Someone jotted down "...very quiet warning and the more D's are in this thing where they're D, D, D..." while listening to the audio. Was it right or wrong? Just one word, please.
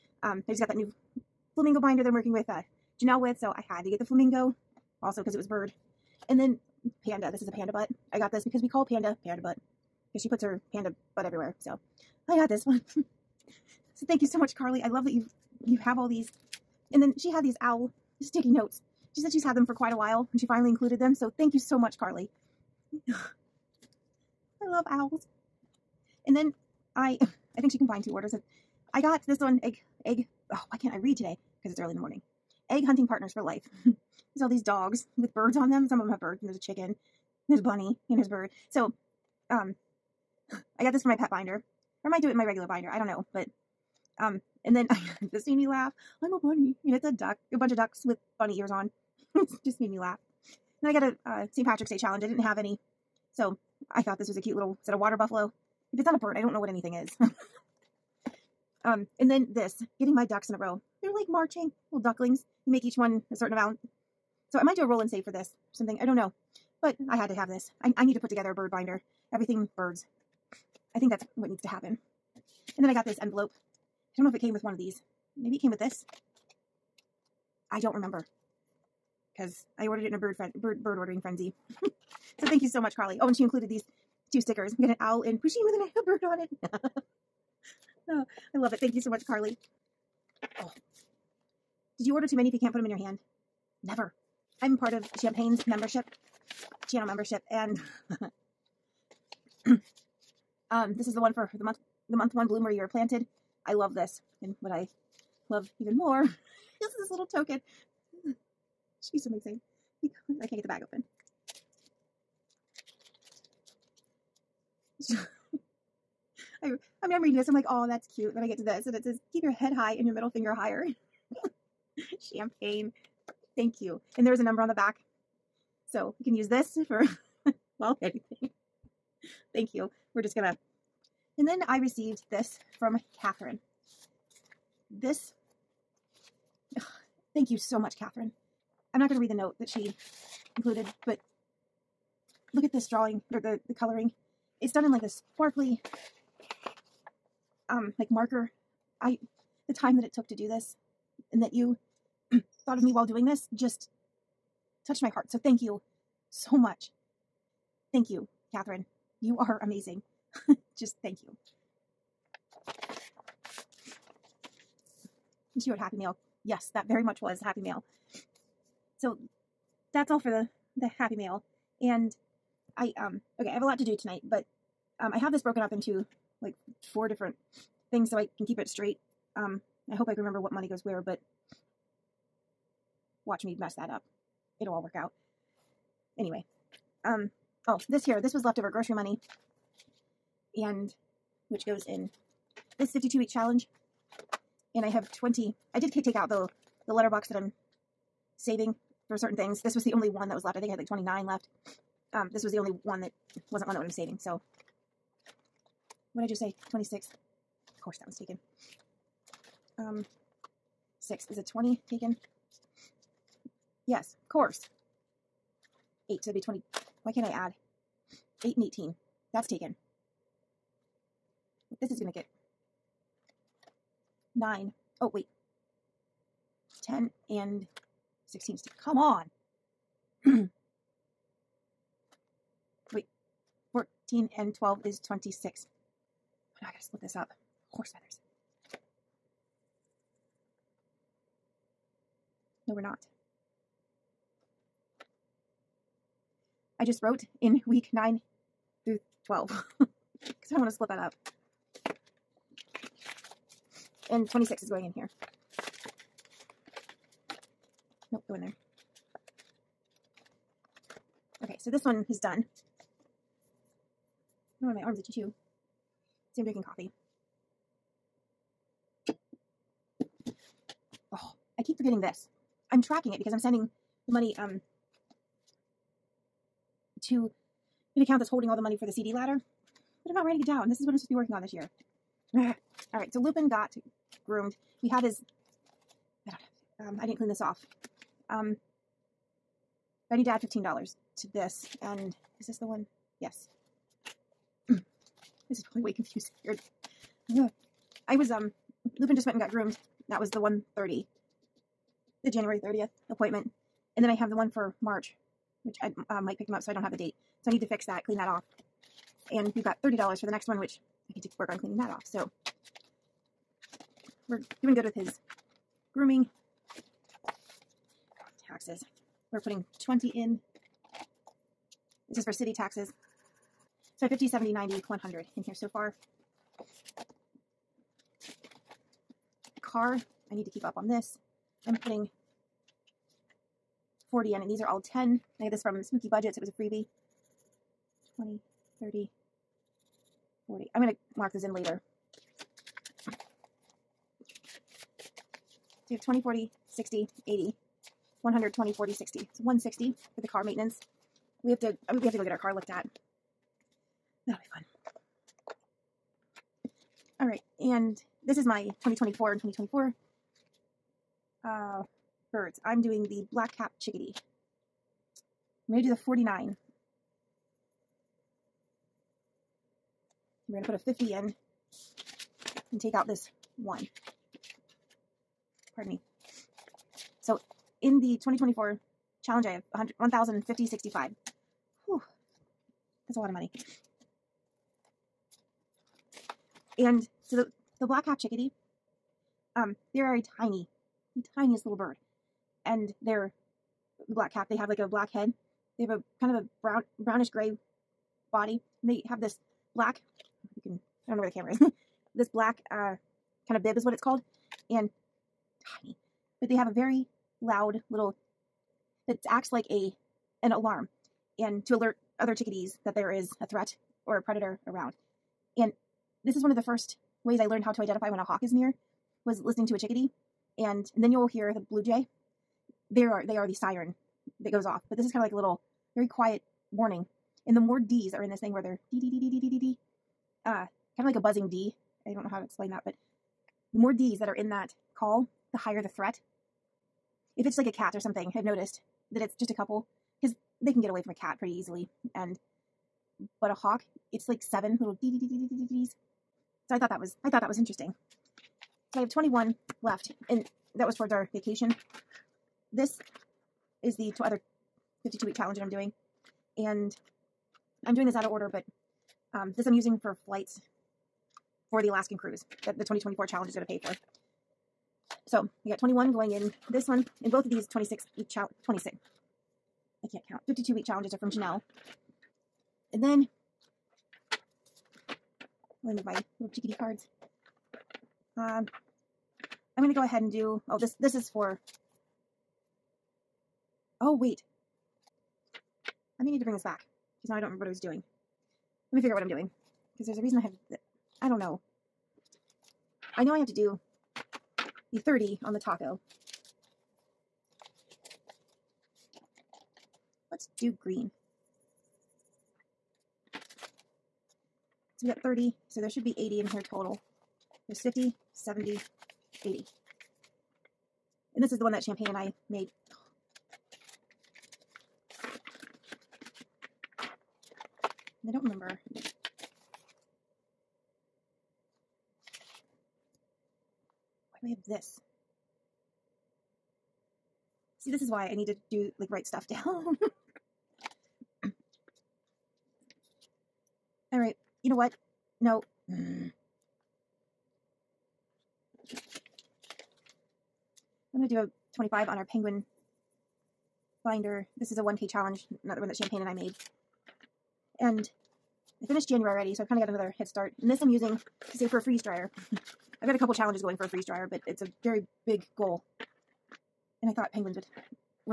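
right.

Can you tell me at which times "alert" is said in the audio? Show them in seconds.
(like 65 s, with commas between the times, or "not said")
411 s.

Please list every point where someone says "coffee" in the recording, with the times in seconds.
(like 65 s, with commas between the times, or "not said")
266 s.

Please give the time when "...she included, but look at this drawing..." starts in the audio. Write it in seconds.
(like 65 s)
139 s.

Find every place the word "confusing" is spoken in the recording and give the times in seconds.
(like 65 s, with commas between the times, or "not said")
295 s.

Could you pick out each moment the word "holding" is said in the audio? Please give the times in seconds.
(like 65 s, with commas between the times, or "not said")
278 s.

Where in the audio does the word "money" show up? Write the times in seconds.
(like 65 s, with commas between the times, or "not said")
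180 s, 188 s, 274 s, 278 s, 383 s.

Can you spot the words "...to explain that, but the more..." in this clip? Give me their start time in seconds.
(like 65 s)
432 s.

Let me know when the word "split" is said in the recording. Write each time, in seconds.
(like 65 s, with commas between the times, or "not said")
236 s, 250 s.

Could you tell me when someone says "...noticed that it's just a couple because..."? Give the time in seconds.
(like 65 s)
438 s.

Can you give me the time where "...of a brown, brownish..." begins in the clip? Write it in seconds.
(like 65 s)
396 s.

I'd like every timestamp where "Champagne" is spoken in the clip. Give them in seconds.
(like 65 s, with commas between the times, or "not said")
95 s, 122 s, 511 s, 545 s.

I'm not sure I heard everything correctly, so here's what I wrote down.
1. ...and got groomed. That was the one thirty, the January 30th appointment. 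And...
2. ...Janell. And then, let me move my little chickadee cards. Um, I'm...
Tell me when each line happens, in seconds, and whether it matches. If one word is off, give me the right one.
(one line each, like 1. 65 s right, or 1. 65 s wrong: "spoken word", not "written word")
1. 299 s right
2. 471 s right.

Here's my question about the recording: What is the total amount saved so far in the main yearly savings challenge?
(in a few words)
$1,050.65.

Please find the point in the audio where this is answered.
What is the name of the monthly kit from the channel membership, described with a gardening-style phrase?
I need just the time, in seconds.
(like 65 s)
102 s.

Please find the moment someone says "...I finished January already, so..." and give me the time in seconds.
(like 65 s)
548 s.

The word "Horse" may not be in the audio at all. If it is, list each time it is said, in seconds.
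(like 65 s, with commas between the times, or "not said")
237 s.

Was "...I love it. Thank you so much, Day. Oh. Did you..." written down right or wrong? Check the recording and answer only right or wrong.
wrong.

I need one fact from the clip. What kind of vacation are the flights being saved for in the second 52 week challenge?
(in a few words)
Alaskan cruise.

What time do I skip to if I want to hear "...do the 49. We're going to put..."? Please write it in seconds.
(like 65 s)
365 s.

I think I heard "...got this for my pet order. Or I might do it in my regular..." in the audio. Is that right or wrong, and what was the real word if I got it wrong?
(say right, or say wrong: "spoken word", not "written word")
wrong: "binder", not "order".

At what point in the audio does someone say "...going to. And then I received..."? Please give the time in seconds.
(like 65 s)
130 s.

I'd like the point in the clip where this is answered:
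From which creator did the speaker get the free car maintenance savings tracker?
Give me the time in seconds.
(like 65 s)
335 s.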